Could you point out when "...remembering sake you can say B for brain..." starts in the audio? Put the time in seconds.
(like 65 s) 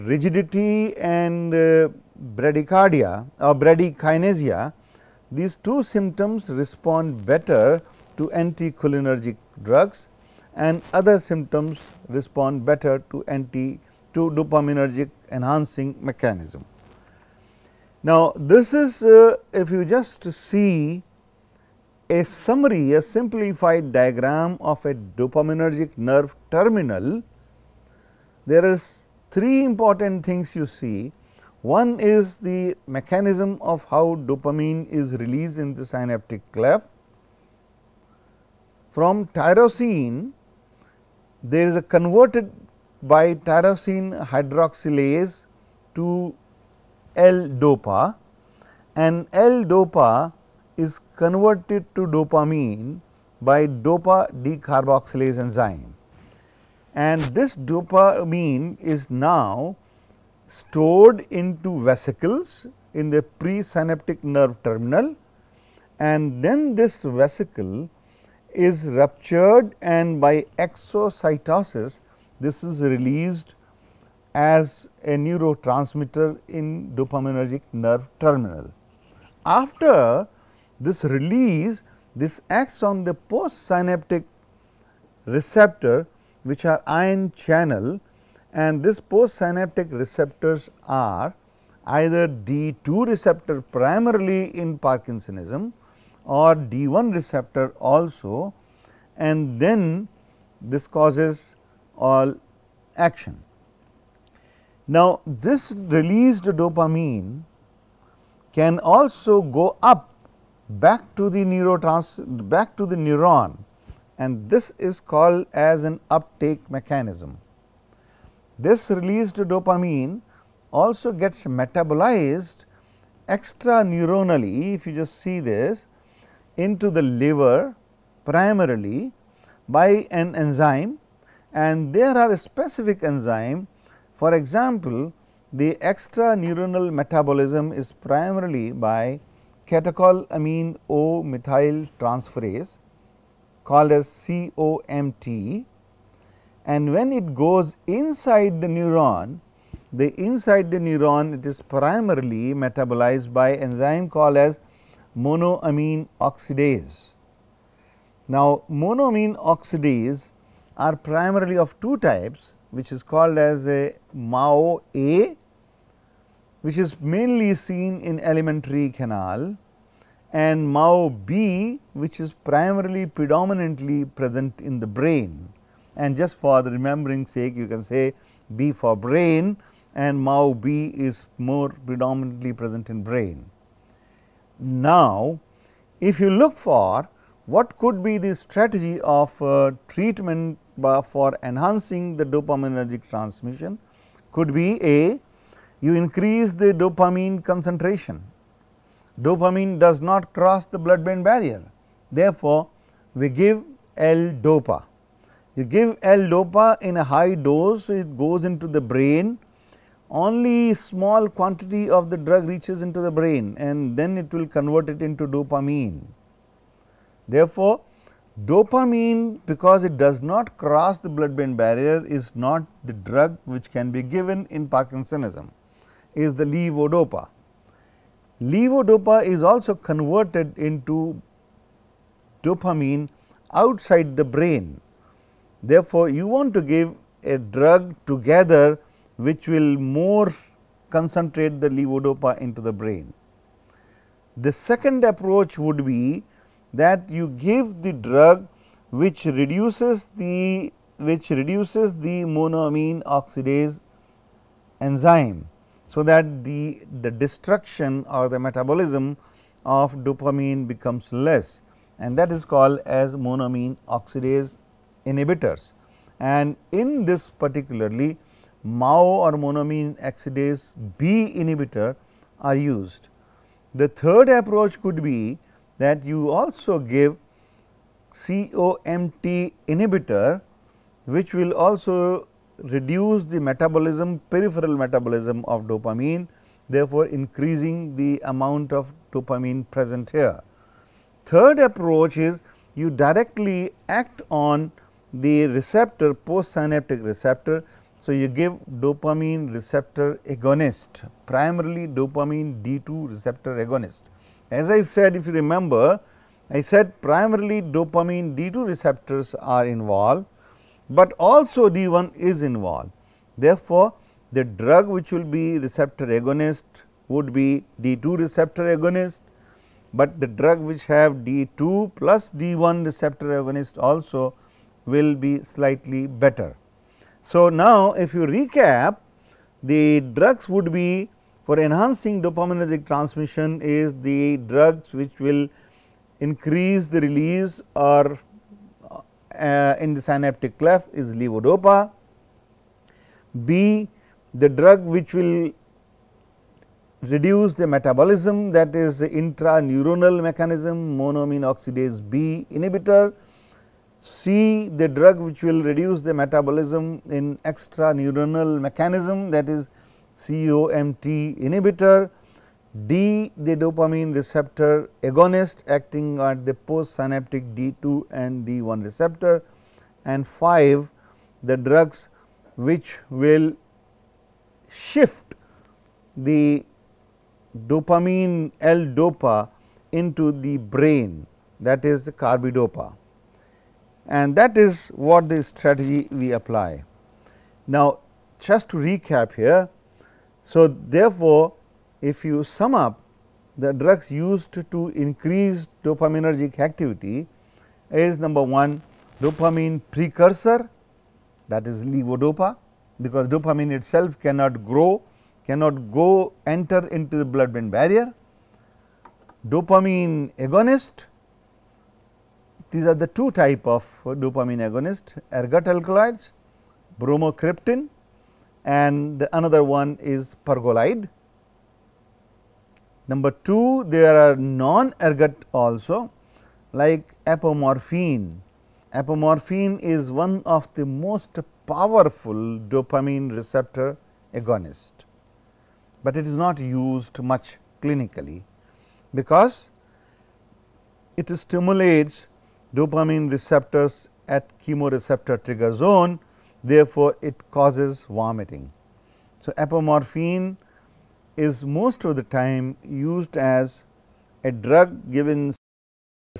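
176 s.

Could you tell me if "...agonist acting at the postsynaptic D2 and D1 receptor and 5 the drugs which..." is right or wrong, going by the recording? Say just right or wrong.
right.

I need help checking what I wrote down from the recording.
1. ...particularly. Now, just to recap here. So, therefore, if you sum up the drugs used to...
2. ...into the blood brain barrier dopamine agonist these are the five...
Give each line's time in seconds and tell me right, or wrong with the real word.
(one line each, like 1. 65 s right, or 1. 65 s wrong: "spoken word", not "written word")
1. 386 s wrong: "apply", not "particularly"
2. 406 s wrong: "two", not "five".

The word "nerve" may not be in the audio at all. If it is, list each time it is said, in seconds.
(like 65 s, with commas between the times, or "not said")
25 s, 64 s, 77 s.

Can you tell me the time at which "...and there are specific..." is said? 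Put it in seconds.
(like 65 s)
131 s.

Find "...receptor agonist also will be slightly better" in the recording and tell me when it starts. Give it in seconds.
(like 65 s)
322 s.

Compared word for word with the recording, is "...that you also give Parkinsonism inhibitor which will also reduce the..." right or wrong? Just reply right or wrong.
wrong.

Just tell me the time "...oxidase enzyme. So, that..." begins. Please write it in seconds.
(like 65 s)
253 s.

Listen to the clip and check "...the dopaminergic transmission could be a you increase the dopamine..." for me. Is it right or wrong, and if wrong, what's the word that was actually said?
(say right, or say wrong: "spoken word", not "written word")
right.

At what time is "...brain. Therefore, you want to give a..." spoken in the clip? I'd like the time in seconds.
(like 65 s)
234 s.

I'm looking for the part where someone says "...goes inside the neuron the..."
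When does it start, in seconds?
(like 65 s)
147 s.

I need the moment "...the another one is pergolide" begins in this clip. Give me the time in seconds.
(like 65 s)
419 s.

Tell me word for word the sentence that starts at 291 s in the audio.
Third approach is you directly act on the receptor postsynaptic receptor so, you give dopamine receptor agonist, primarily dopamine D2 receptor agonist.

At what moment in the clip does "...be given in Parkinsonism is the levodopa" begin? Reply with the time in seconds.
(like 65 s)
223 s.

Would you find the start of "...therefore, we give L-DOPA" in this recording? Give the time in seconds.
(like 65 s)
202 s.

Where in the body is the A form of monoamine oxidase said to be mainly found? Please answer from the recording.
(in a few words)
alimentary canal.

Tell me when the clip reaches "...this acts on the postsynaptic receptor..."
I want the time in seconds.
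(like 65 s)
82 s.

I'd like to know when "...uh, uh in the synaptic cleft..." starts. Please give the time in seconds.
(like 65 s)
338 s.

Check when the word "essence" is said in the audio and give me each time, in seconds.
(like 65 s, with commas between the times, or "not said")
not said.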